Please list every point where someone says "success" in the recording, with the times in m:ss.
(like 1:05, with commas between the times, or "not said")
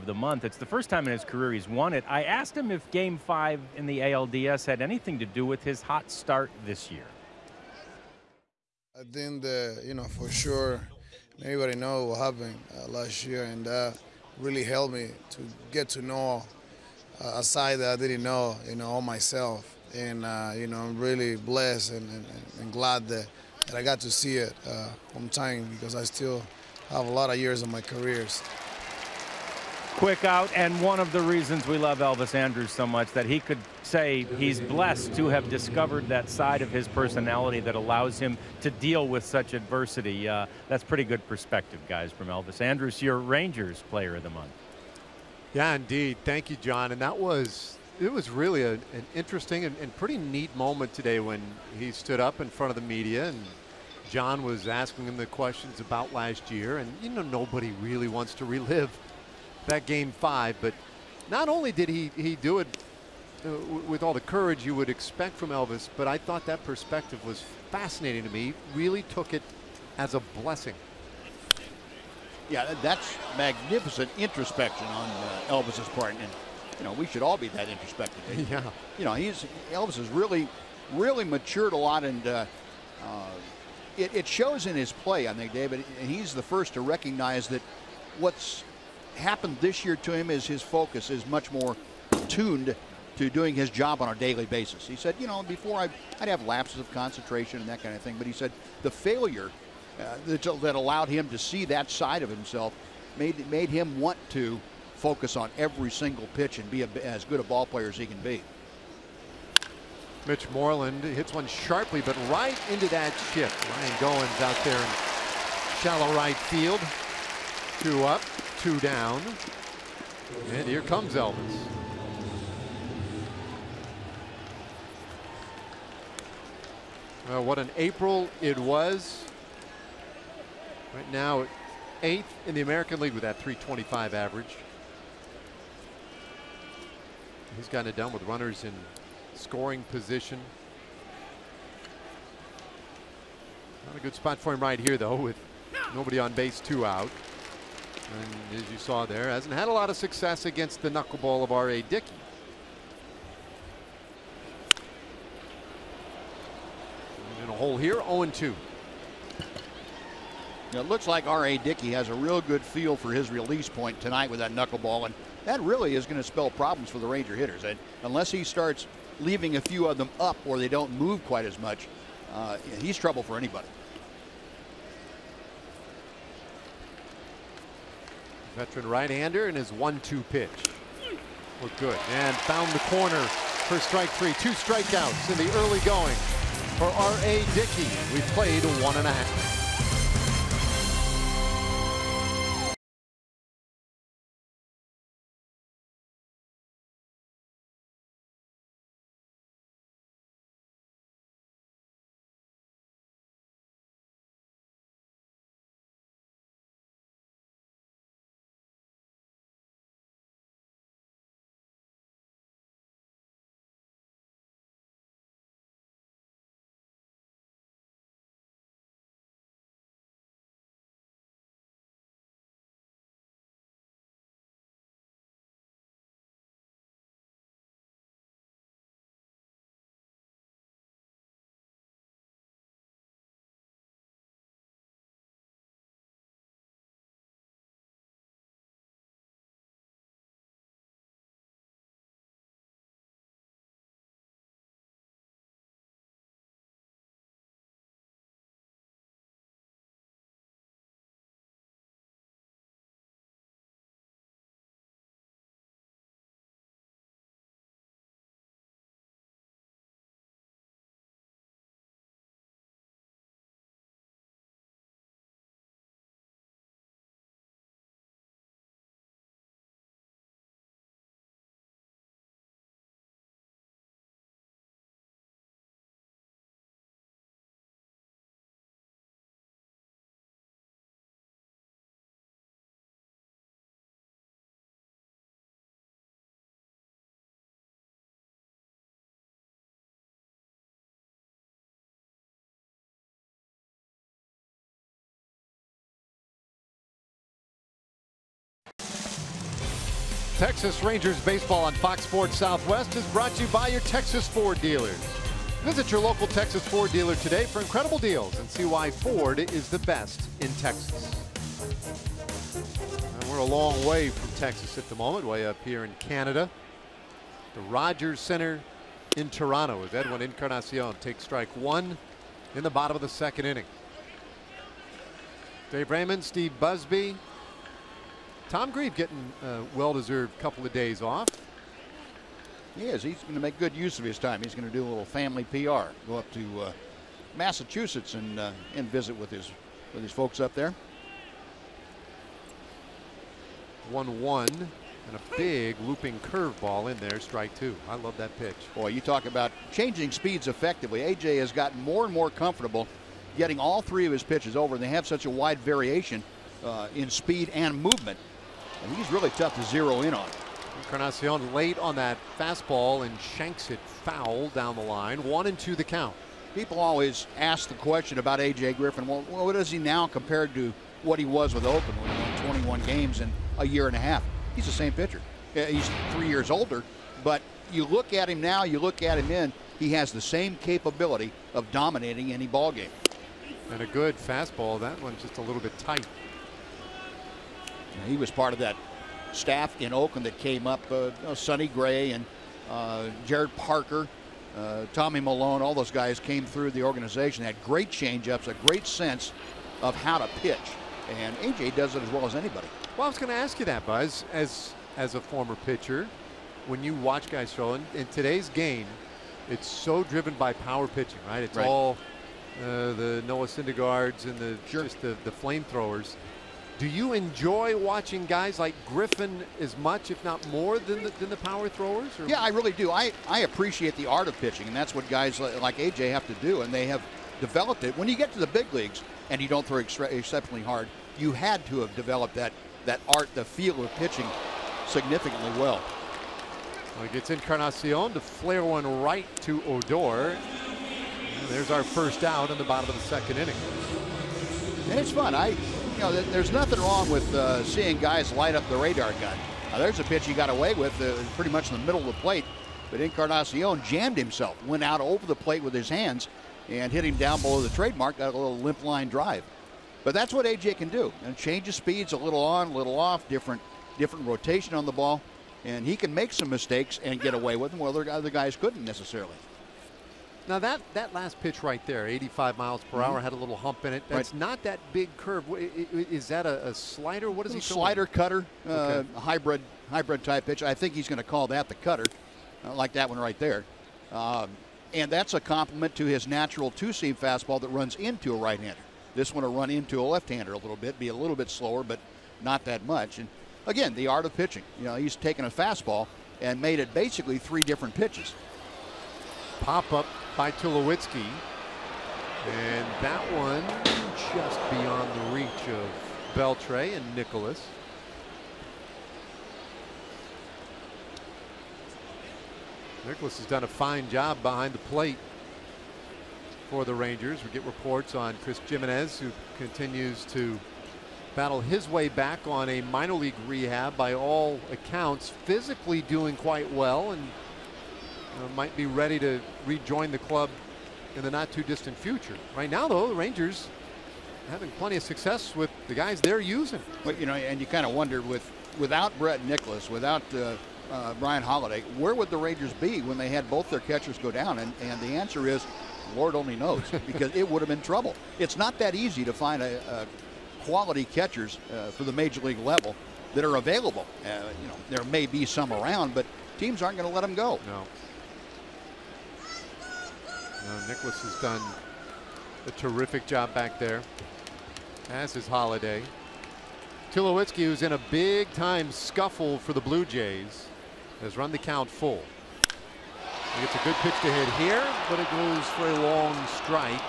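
2:29, 8:55.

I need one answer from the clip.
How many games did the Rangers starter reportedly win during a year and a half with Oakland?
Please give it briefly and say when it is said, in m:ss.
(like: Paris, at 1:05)
21, at 6:12.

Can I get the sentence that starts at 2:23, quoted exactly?
Not a good spot for him right here, though, with nobody on base, two out.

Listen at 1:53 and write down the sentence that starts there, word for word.
Ryan Goins out there in shallow right field.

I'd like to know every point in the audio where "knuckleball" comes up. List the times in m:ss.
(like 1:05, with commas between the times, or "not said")
2:30, 2:44.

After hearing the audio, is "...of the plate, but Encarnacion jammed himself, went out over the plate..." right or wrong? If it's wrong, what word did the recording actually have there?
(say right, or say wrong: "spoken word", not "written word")
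right.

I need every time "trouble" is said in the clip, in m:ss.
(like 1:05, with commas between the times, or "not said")
2:52, 9:07.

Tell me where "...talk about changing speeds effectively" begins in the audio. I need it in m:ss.
5:49.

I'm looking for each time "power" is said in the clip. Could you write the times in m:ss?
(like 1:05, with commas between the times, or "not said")
6:50, 7:01.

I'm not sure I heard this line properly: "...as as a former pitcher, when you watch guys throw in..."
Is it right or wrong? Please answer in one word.
right.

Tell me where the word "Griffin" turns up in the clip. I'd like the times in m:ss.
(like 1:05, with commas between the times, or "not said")
6:08, 6:58.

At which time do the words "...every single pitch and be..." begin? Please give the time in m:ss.
1:45.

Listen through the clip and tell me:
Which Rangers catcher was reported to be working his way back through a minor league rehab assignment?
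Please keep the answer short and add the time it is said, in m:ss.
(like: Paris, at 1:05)
Chris Gimenez, at 8:38.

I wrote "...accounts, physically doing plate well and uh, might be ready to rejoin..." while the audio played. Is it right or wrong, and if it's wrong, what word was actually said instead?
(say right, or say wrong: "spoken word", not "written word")
wrong: "quite", not "plate".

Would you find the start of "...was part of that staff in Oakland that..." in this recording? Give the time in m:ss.
6:28.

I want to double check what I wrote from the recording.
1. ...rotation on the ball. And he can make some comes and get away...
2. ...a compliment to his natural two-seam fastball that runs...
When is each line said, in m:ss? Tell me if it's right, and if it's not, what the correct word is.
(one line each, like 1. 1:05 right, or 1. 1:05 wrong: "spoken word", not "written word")
1. 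7:44 wrong: "mistakes", not "comes"
2. 8:05 right.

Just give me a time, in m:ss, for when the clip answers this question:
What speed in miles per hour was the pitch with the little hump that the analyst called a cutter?
7:52.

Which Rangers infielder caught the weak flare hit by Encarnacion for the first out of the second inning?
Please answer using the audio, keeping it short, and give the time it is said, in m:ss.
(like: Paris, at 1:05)
Odor, at 7:19.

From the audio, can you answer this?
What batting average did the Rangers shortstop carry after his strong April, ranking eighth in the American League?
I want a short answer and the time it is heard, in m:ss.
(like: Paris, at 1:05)
.325, at 2:13.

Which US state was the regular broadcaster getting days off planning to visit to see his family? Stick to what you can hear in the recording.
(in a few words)
Massachusetts.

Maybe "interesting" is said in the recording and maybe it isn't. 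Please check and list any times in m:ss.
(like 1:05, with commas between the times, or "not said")
0:49.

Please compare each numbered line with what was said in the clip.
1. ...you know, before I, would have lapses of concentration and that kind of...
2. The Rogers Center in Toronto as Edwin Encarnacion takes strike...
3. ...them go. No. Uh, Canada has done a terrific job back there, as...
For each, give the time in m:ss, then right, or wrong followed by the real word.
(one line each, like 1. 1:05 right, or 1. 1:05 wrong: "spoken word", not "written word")
1. 1:35 right
2. 5:17 right
3. 9:17 wrong: "Nicholas", not "Canada".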